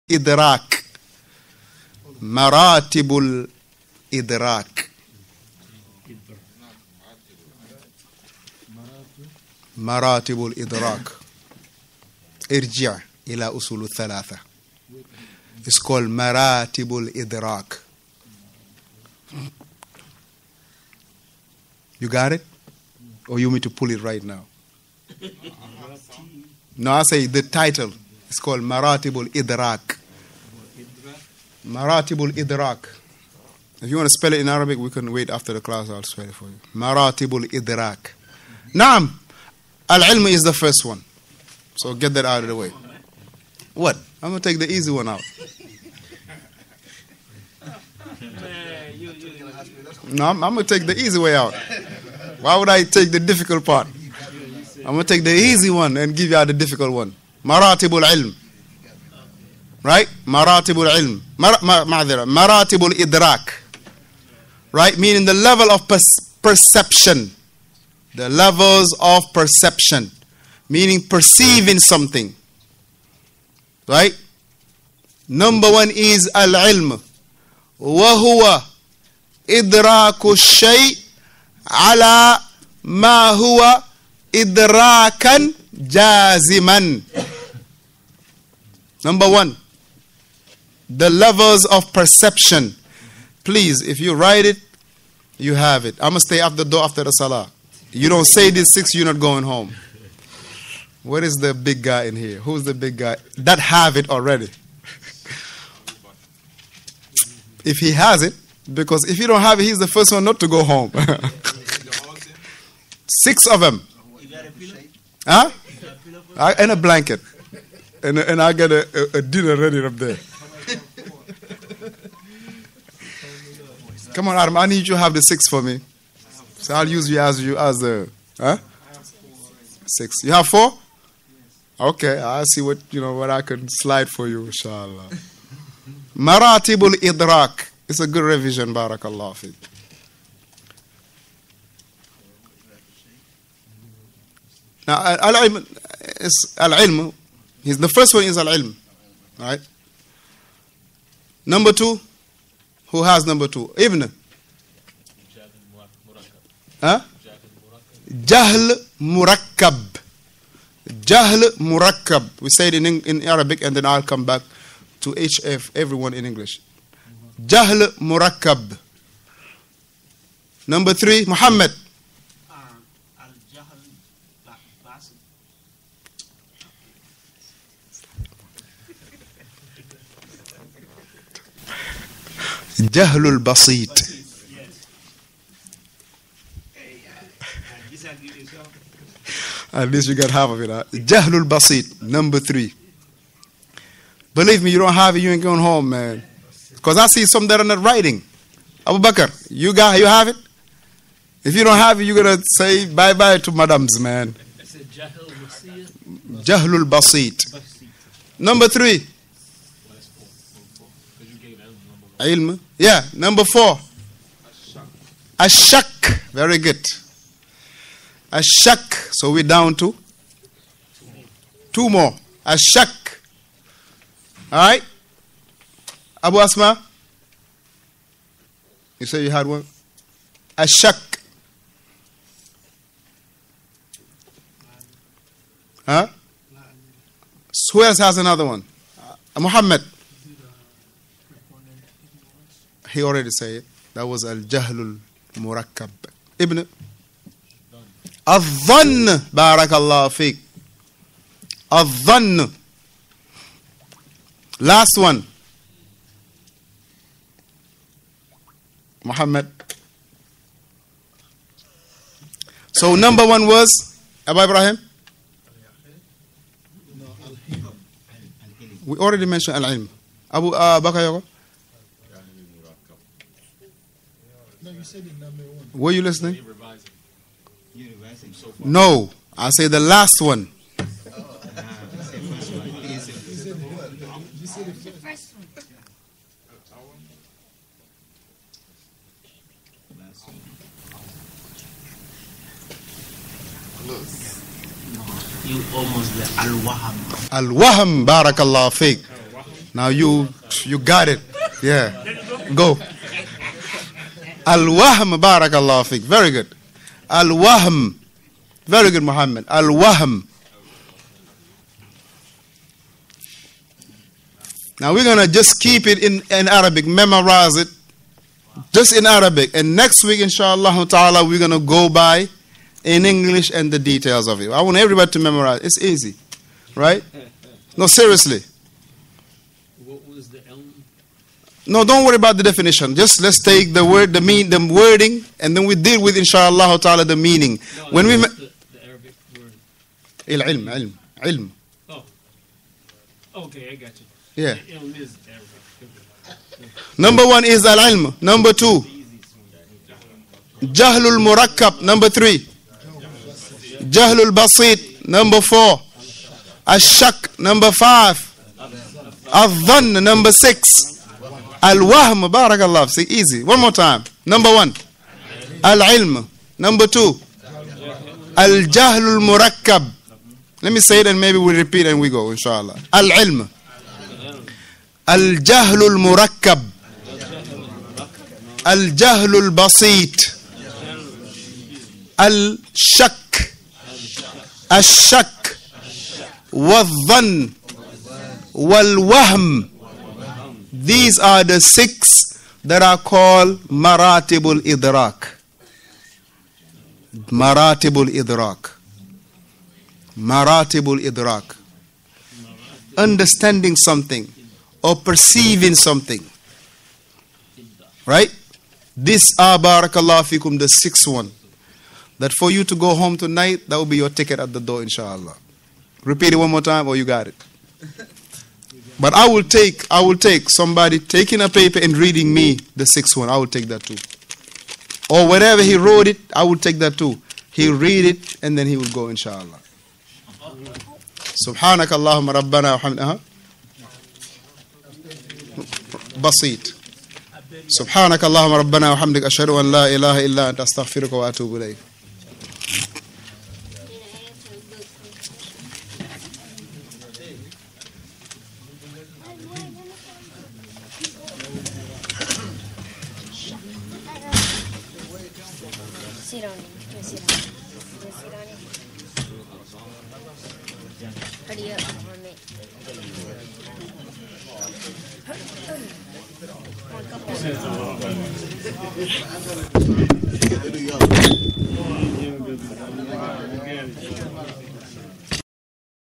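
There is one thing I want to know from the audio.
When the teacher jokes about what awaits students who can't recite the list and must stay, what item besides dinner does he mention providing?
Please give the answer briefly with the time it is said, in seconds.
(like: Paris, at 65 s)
a blanket, at 116 s.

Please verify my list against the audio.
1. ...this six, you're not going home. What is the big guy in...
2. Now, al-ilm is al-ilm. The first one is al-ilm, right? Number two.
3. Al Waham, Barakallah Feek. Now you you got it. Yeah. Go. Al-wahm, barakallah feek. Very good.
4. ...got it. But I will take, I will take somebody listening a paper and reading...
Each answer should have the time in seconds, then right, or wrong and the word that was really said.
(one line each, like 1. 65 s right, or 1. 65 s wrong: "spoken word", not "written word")
1. 98 s right
2. 144 s right
3. 297 s right
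4. 417 s wrong: "taking", not "listening".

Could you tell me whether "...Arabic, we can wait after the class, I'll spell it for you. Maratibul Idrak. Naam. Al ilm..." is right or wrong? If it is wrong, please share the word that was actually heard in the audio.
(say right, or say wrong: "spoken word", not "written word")
right.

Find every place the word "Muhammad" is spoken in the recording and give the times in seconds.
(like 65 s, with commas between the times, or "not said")
171 s, 239 s, 259 s, 309 s.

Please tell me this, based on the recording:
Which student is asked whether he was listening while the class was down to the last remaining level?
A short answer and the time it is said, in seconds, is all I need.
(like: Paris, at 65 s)
Bakayoko, at 270 s.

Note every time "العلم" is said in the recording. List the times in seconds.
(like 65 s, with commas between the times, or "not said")
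365 s, 372 s.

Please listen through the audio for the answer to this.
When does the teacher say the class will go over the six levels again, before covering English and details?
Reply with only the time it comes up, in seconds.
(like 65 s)
319 s.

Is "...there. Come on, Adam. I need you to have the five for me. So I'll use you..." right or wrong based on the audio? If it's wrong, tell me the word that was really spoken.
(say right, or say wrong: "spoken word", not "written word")
wrong: "six", not "five".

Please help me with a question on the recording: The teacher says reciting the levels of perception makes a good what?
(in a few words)
revision.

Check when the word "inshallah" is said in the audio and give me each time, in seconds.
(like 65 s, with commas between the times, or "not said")
134 s, 320 s, 336 s, 372 s, 414 s, 429 s.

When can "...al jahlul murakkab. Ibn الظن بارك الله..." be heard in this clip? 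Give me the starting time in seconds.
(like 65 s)
244 s.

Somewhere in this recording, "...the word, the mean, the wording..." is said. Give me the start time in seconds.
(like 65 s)
333 s.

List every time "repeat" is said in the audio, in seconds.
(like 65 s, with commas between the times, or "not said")
371 s, 416 s.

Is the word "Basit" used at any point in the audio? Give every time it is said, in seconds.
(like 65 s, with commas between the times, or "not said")
183 s, 191 s, 206 s, 354 s.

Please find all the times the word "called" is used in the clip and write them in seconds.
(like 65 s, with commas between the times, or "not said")
15 s, 28 s, 392 s.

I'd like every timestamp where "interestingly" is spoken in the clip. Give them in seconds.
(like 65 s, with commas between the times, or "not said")
not said.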